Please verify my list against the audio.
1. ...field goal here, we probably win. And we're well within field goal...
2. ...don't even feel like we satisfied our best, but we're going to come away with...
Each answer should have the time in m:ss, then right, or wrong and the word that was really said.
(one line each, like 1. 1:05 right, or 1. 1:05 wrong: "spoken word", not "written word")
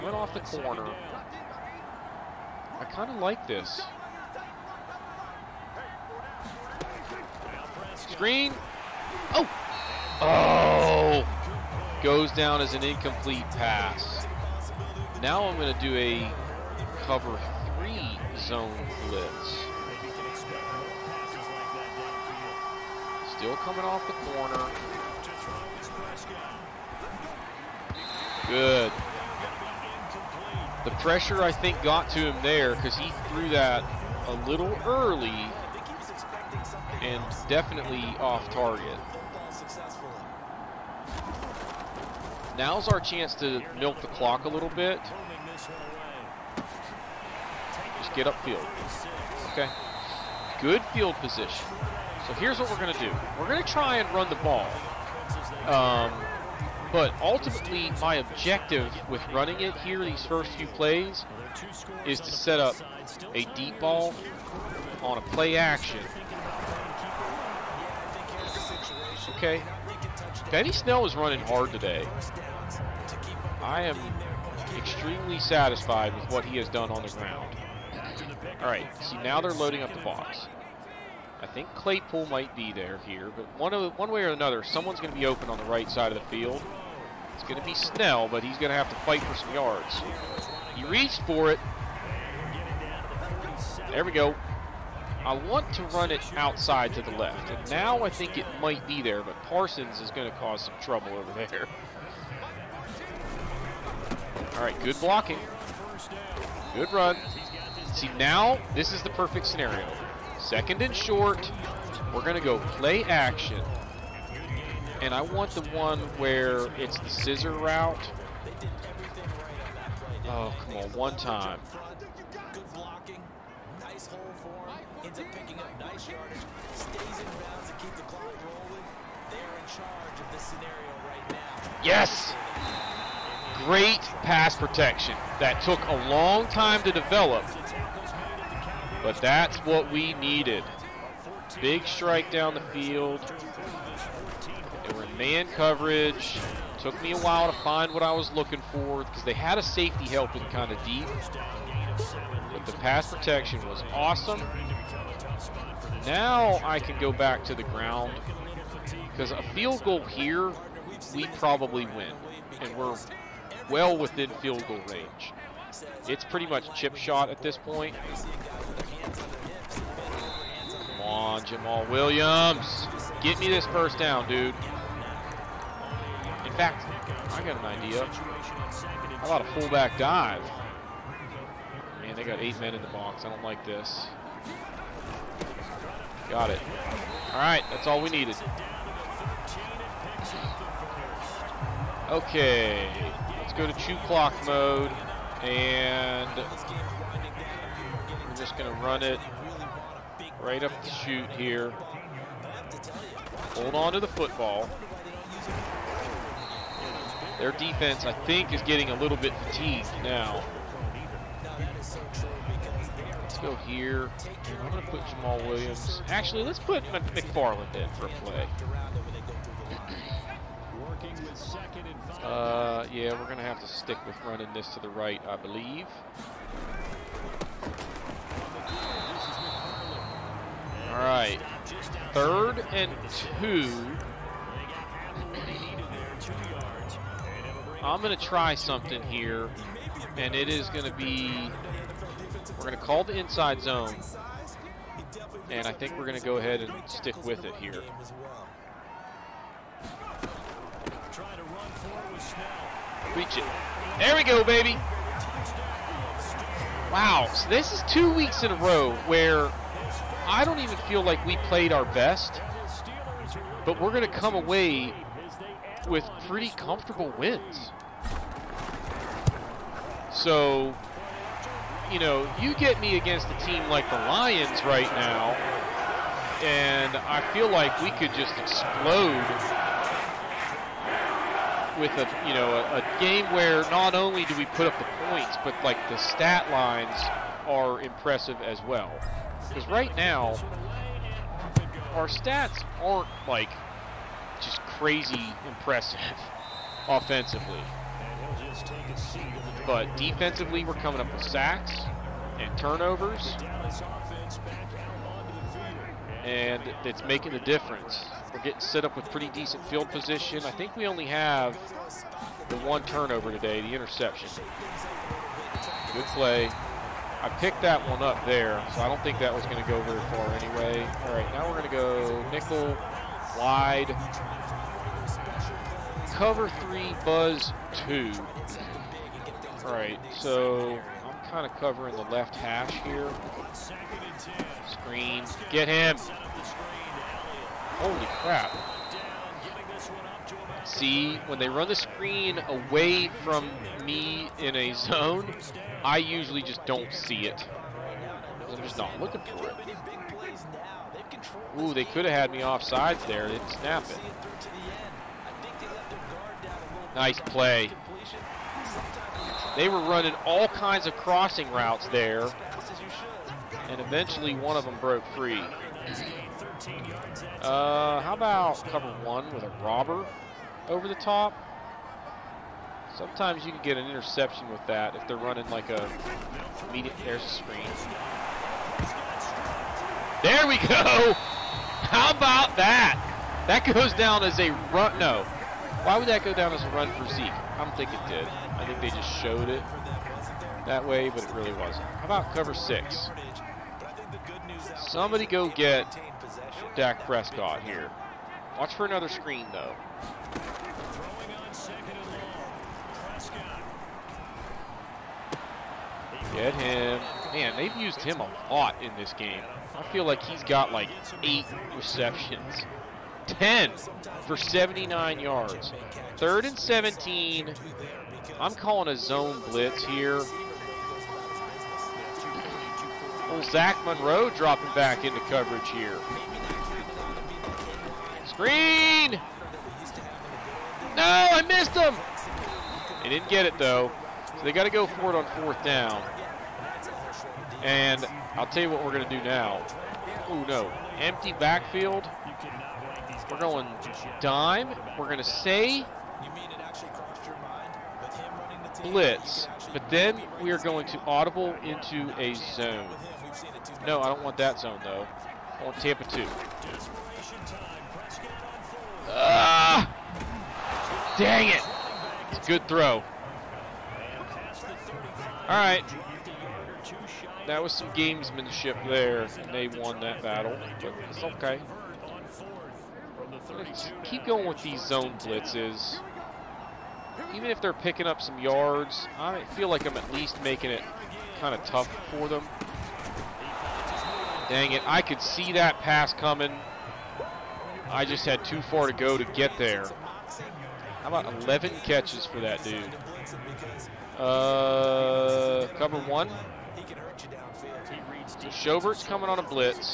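1. 2:39 right
2. 4:20 wrong: "played", not "satisfied".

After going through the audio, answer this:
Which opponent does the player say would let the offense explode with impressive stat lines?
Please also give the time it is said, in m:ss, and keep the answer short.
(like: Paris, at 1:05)
the Lions, at 4:33.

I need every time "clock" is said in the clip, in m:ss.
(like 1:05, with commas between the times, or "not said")
0:44, 3:14.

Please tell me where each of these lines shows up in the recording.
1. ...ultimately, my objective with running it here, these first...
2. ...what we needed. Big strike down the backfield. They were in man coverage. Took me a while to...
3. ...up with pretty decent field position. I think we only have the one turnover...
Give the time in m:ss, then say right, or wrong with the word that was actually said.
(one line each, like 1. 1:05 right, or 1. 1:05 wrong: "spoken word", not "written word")
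1. 0:57 right
2. 2:19 wrong: "field", not "backfield"
3. 5:08 right.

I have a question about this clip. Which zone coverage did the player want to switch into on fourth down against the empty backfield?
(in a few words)
Tampa 2.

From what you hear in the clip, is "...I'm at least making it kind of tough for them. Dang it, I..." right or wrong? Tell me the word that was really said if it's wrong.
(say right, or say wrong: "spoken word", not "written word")
right.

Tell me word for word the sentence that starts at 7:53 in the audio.
Let's keep going with these zone blitzes.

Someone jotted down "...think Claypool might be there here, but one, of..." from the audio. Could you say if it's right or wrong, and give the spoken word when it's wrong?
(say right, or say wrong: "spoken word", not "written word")
right.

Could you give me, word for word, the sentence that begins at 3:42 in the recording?
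Uh, yeah, we're going to have to stick with running this to the right, I believe.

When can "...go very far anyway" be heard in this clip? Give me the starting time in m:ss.
5:19.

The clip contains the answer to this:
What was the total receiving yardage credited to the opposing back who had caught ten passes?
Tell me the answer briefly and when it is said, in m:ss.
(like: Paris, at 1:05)
79 yards, at 6:54.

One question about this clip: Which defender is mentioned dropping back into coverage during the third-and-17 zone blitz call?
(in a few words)
Zach Monroe.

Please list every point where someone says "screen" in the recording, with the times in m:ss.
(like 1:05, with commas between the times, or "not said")
0:08, 5:34, 5:41, 6:17, 6:39, 7:08.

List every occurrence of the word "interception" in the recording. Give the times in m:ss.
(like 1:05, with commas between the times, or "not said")
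5:13, 6:13.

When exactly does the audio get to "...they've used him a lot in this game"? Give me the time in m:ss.
6:47.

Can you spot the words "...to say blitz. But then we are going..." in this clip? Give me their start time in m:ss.
7:25.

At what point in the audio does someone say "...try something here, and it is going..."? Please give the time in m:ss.
3:58.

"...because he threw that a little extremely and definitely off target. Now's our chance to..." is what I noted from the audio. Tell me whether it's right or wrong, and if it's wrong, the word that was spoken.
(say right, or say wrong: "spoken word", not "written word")
wrong: "early", not "extremely".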